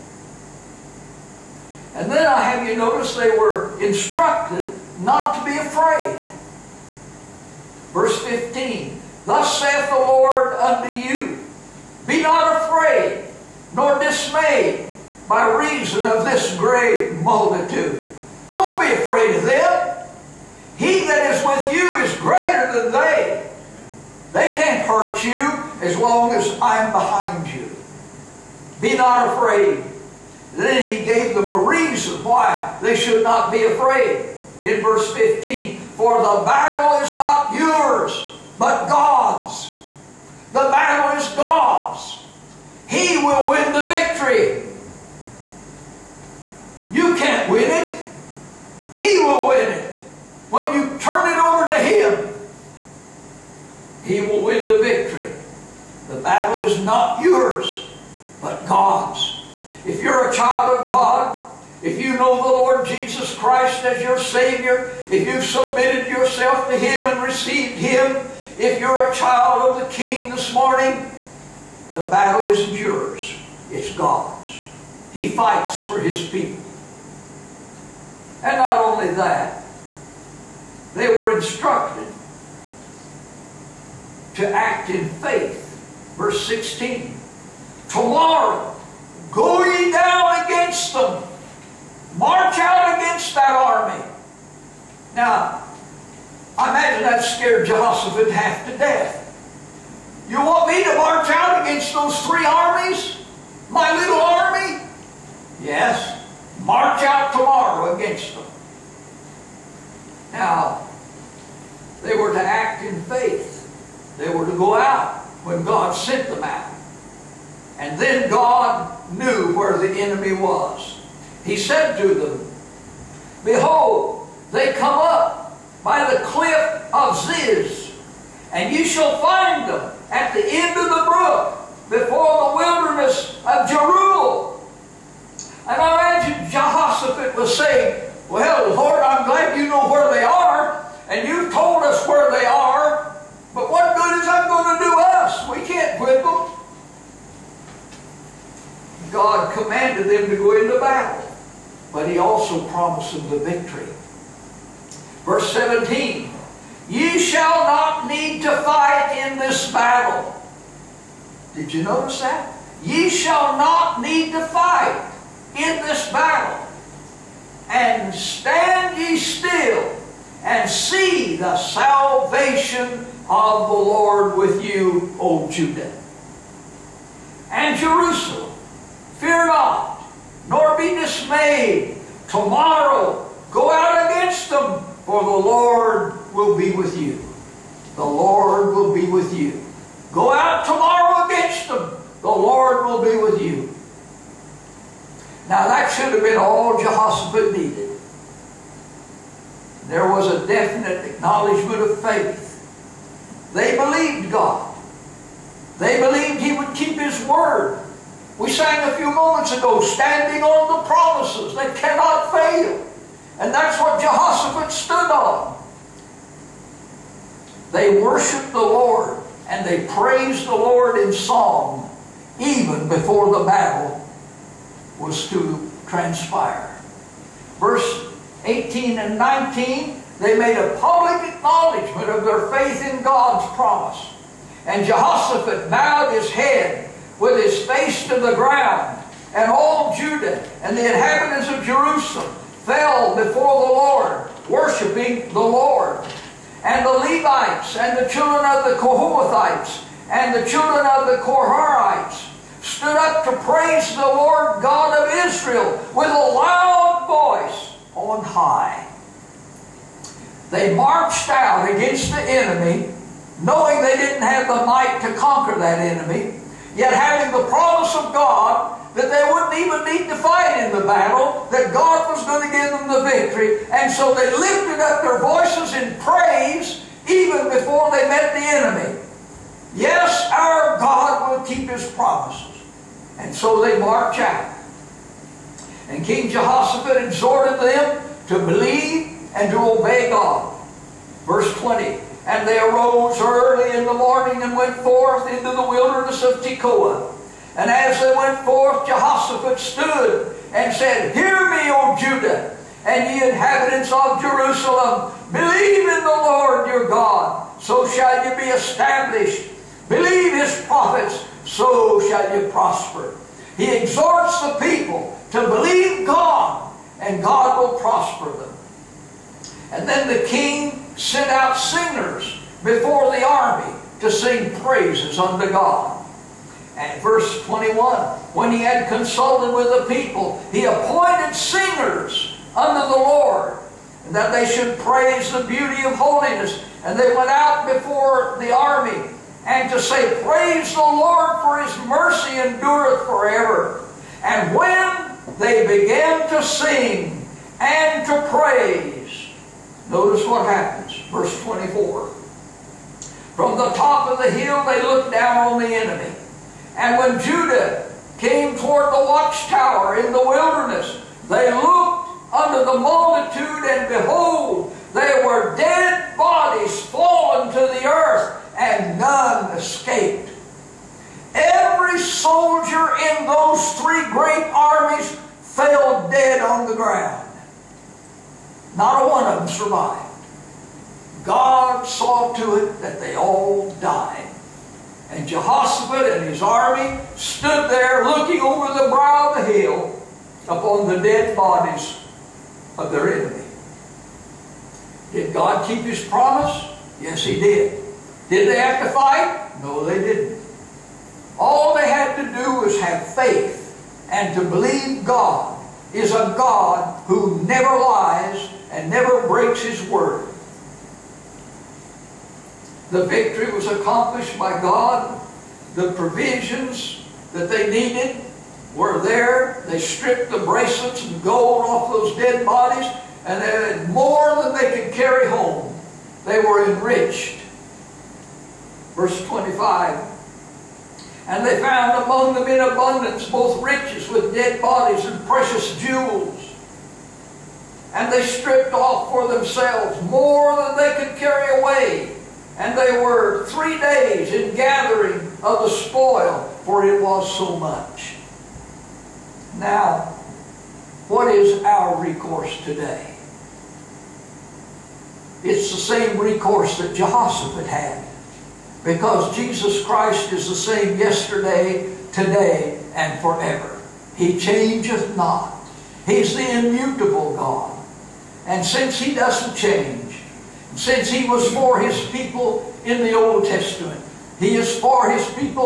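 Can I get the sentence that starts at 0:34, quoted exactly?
In verse 15, For the battle is not yours, but God's.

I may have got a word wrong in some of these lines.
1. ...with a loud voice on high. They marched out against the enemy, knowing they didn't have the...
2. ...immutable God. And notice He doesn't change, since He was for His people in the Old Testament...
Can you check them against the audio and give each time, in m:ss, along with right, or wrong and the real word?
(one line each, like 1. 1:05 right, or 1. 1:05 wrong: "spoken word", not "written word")
1. 4:15 right
2. 7:46 wrong: "since", not "notice".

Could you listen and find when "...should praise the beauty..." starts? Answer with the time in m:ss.
5:34.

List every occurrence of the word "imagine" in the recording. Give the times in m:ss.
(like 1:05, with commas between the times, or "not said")
1:36, 2:15.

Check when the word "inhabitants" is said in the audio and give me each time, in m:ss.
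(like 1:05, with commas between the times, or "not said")
4:00, 5:03.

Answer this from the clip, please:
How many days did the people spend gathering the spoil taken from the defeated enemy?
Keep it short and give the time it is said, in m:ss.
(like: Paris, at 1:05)
3, at 7:23.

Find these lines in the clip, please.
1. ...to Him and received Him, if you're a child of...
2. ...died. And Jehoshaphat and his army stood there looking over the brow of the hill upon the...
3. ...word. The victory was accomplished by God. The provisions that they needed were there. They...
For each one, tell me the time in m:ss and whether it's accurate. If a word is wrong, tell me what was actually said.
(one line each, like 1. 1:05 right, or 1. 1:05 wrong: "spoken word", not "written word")
1. 1:06 right
2. 6:23 right
3. 6:49 right.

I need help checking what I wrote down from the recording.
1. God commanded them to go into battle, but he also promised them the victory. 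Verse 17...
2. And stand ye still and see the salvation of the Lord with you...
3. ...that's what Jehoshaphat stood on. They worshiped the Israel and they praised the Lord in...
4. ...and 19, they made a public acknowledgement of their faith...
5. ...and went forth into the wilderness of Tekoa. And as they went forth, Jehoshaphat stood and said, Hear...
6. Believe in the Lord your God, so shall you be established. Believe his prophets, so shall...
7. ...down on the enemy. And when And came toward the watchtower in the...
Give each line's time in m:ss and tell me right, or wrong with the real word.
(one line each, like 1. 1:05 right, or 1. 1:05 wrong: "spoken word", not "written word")
1. 2:29 right
2. 2:47 right
3. 3:33 wrong: "Lord", not "Israel"
4. 3:48 right
5. 4:54 right
6. 5:05 right
7. 5:55 wrong: "Judah", not "And".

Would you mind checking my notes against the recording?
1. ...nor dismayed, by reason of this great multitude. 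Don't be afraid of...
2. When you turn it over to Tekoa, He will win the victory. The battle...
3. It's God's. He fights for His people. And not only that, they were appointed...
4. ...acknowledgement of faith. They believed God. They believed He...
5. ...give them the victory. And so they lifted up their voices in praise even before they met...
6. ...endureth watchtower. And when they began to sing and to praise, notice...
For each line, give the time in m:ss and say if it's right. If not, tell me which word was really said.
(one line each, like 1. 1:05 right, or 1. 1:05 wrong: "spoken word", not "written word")
1. 0:13 right
2. 0:50 wrong: "Him", not "Tekoa"
3. 1:13 wrong: "instructed", not "appointed"
4. 3:21 right
5. 4:32 right
6. 5:42 wrong: "forever", not "watchtower".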